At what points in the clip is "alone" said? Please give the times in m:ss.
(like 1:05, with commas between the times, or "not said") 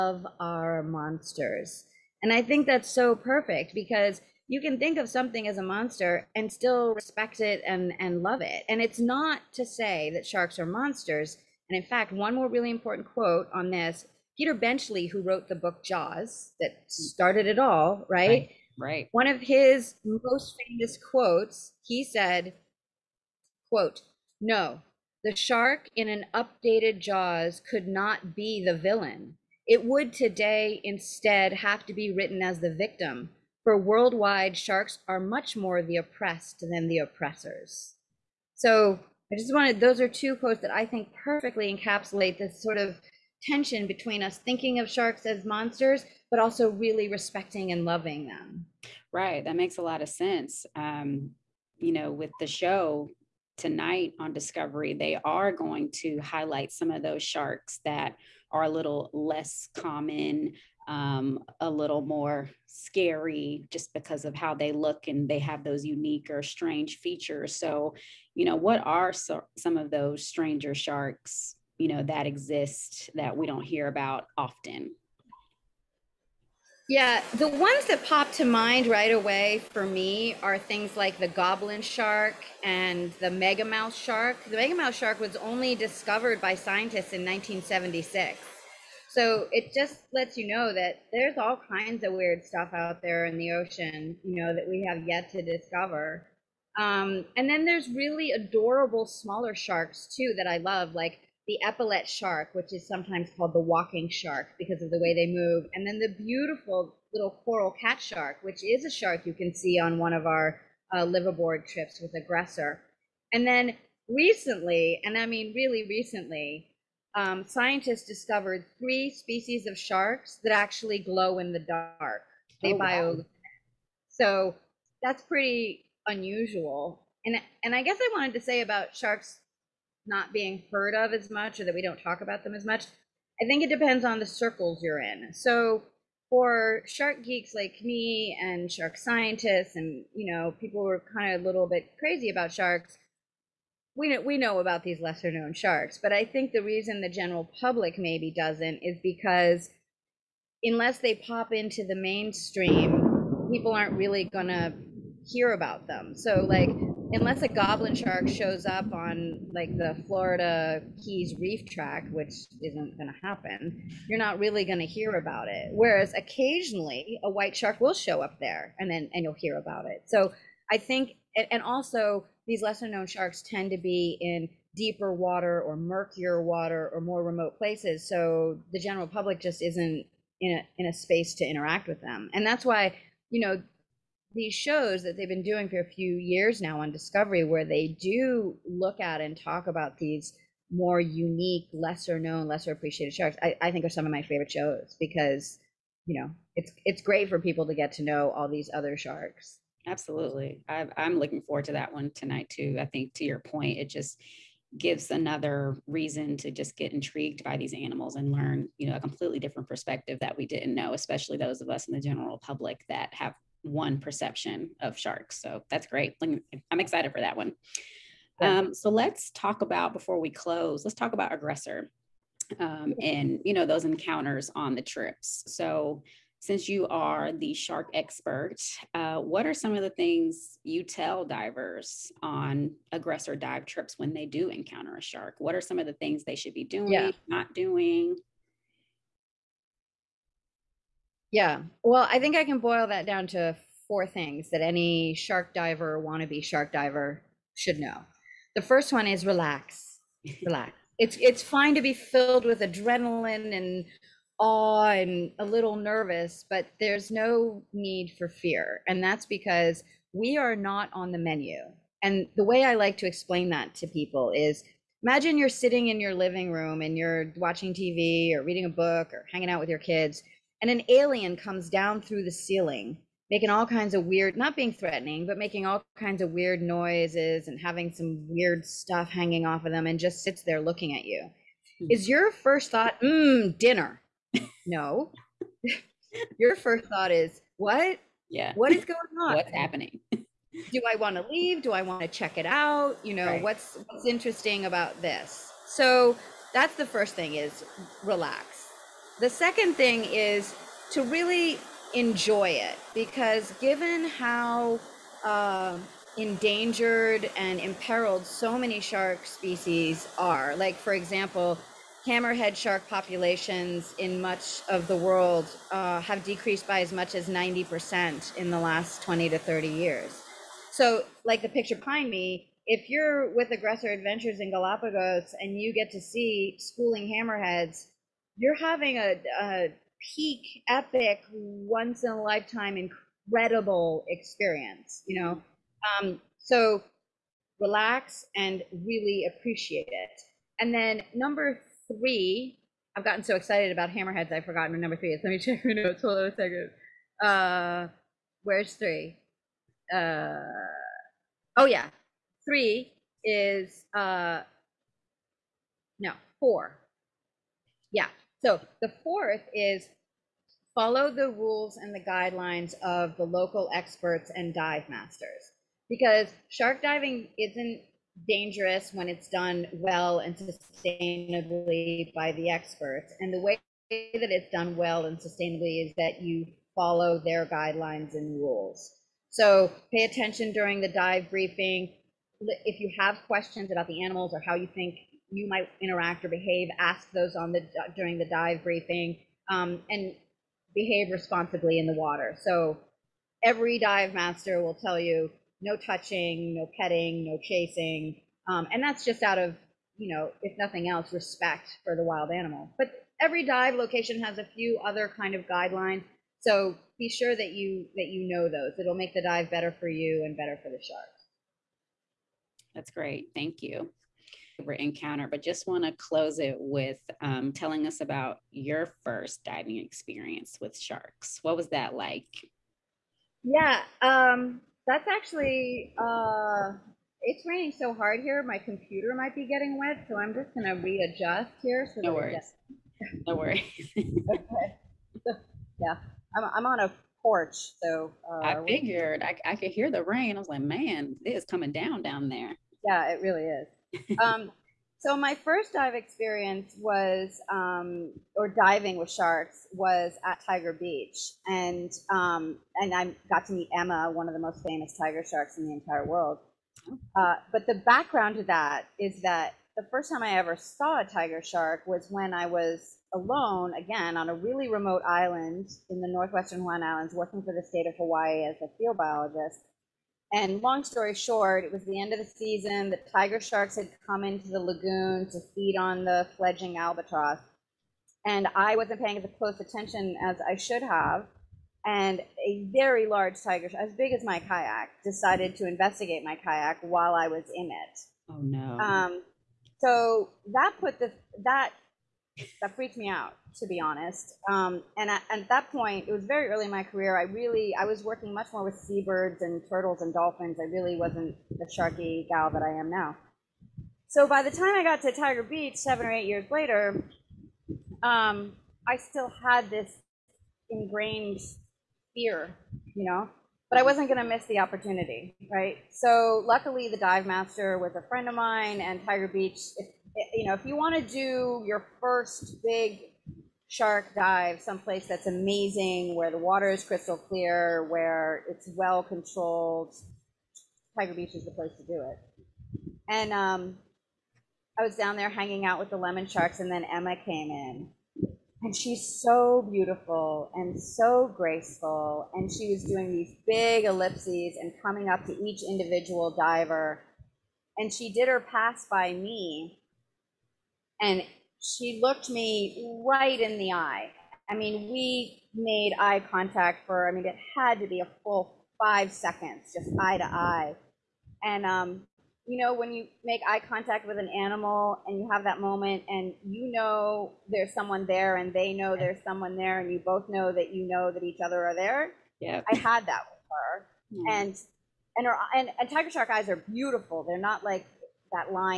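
7:43.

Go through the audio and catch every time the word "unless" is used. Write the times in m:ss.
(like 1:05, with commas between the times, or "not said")
2:30, 2:37.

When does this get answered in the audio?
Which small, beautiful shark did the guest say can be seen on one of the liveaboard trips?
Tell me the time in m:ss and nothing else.
1:47.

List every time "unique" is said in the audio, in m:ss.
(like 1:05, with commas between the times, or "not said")
1:05, 3:10.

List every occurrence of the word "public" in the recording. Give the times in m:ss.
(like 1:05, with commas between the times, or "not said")
2:27, 2:59, 3:32.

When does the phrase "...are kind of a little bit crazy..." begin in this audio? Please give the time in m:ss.
2:20.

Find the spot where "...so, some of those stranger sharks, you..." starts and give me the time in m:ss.
1:09.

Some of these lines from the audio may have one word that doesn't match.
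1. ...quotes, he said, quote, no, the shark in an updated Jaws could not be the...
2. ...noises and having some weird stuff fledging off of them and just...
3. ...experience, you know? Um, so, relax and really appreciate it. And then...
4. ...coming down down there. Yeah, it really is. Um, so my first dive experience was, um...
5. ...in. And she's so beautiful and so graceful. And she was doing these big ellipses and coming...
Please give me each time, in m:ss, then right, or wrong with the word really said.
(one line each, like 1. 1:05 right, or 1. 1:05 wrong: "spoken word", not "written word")
1. 0:20 right
2. 4:36 wrong: "hanging", not "fledging"
3. 5:34 right
4. 7:21 right
5. 8:57 right.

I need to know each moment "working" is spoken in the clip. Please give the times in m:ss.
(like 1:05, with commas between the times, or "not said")
7:47, 8:18.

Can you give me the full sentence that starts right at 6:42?
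But every dive location has a few other kind of guidelines.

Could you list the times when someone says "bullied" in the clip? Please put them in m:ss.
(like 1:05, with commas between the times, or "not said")
not said.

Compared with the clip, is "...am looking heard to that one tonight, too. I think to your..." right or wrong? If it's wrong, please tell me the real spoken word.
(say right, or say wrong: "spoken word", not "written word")
wrong: "forward", not "heard".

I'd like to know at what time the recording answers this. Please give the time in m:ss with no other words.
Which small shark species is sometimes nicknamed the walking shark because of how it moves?
1:41.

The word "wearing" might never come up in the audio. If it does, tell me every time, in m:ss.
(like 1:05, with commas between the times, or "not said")
not said.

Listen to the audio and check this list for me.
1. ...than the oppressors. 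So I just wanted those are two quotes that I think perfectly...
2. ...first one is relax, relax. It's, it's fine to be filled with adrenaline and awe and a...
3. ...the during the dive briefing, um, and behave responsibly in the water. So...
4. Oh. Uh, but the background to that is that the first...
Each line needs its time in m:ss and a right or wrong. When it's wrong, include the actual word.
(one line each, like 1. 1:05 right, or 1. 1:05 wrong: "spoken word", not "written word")
1. 0:36 right
2. 4:08 right
3. 6:27 right
4. 7:36 right.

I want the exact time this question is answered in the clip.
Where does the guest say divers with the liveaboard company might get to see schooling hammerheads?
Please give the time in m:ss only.
5:24.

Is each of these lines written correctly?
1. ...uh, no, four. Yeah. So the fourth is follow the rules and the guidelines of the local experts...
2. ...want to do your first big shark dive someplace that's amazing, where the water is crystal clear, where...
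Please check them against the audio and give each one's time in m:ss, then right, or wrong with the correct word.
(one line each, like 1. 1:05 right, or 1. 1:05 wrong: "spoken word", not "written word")
1. 5:53 right
2. 8:40 right.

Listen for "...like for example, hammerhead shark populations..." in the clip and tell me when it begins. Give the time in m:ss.
5:10.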